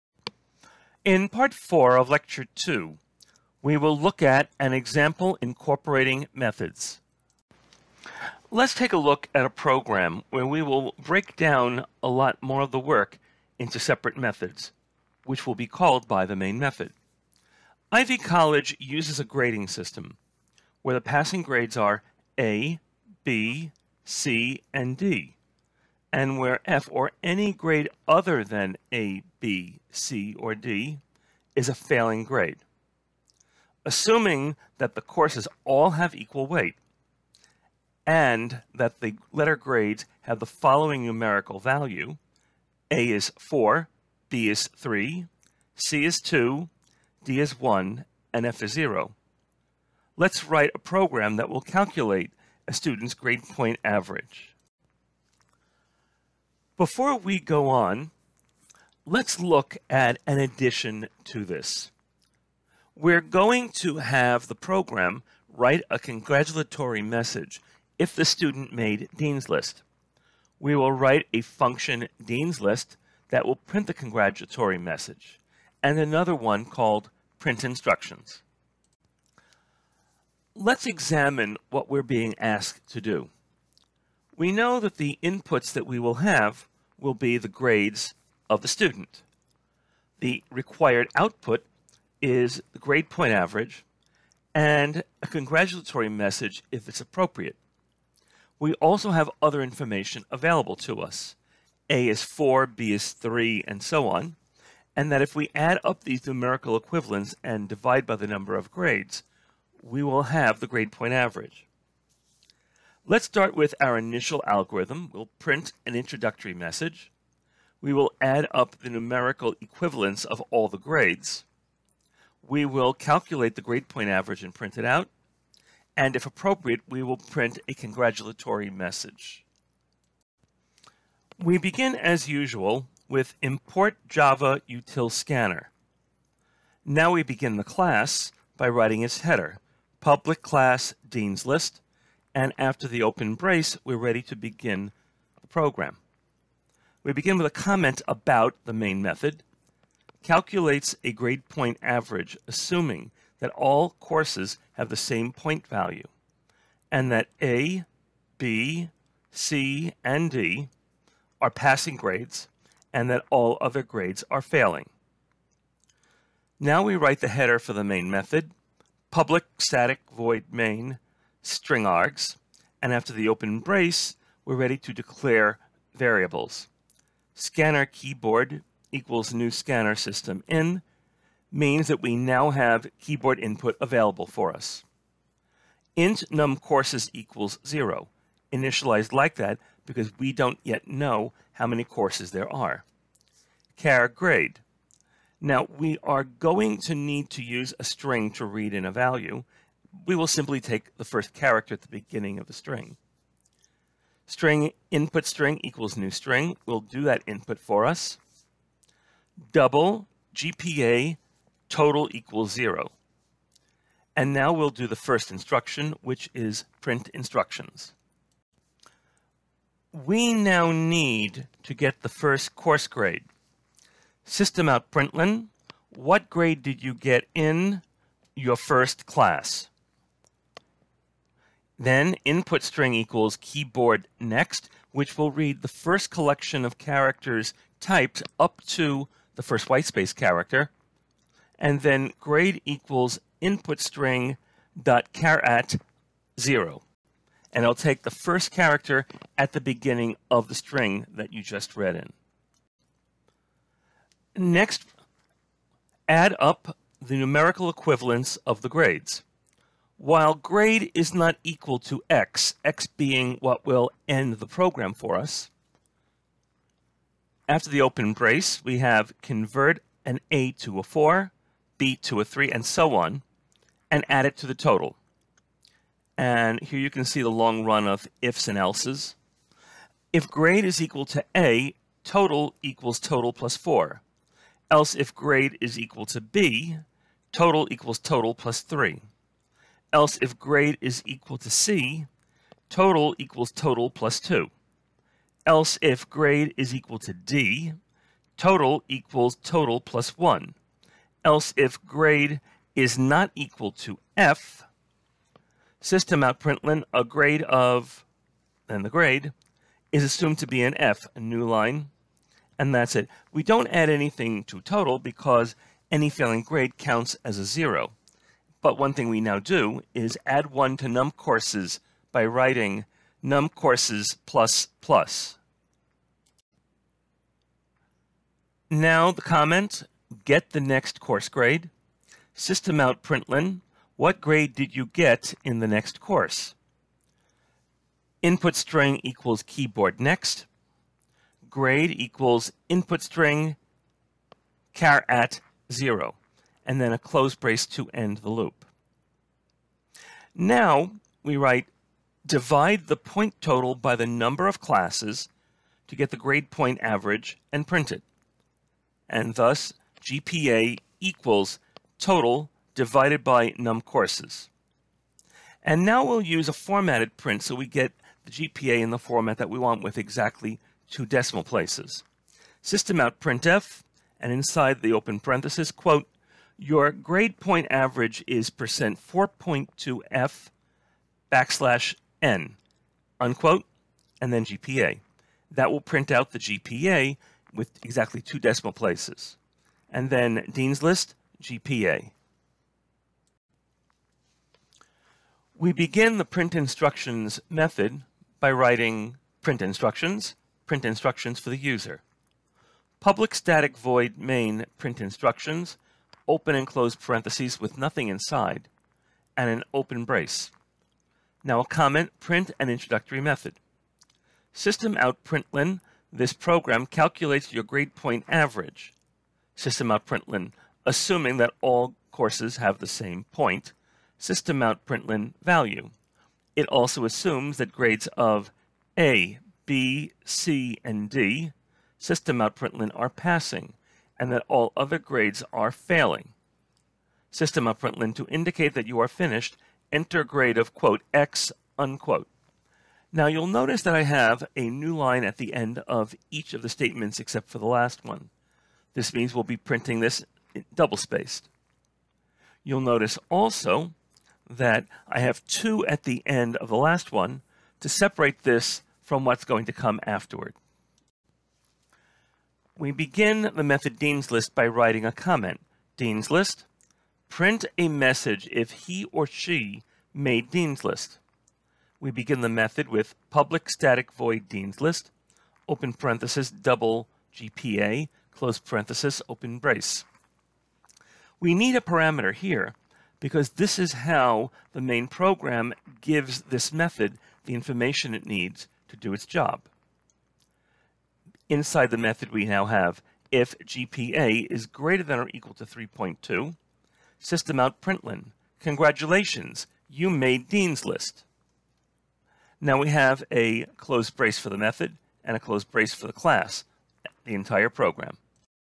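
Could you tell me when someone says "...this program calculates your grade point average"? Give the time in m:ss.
6:56.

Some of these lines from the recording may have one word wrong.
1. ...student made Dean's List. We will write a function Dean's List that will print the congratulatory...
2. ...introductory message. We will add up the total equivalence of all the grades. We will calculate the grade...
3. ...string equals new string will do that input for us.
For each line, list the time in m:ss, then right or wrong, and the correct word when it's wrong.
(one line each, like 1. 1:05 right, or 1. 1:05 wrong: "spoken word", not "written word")
1. 1:08 right
2. 1:55 wrong: "numerical", not "total"
3. 3:25 right.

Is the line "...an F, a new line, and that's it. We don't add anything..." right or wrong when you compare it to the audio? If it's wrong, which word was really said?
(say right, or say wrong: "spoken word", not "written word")
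right.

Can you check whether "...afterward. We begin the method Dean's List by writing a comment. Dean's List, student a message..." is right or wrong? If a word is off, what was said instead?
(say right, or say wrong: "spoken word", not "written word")
wrong: "print", not "student".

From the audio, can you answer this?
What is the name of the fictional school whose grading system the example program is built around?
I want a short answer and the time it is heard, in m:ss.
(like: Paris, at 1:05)
Ivy College, at 0:17.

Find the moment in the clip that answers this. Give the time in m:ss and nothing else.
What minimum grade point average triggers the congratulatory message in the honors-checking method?
8:15.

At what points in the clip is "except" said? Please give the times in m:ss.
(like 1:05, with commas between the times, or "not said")
7:27.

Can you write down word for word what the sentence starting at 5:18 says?
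But one thing we now do is add one to num courses by writing num courses plus plus.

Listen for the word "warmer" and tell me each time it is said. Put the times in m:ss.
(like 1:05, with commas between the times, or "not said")
not said.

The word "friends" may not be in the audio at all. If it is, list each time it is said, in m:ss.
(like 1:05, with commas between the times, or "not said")
not said.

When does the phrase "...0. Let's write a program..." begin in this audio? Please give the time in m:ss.
0:48.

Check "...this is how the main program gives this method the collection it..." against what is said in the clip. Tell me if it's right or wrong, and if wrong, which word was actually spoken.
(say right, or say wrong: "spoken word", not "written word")
wrong: "information", not "collection".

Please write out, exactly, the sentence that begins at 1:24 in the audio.
We know that the inputs that we will have will be the grades of the student.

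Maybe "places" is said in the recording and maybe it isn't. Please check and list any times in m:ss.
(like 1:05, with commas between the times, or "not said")
6:11, 6:28.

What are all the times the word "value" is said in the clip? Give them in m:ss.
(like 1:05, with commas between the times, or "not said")
0:41, 2:35, 3:18, 7:05.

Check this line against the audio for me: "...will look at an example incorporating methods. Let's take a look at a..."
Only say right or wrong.
right.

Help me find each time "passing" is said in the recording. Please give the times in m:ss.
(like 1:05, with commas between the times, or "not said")
0:21, 2:41, 7:13.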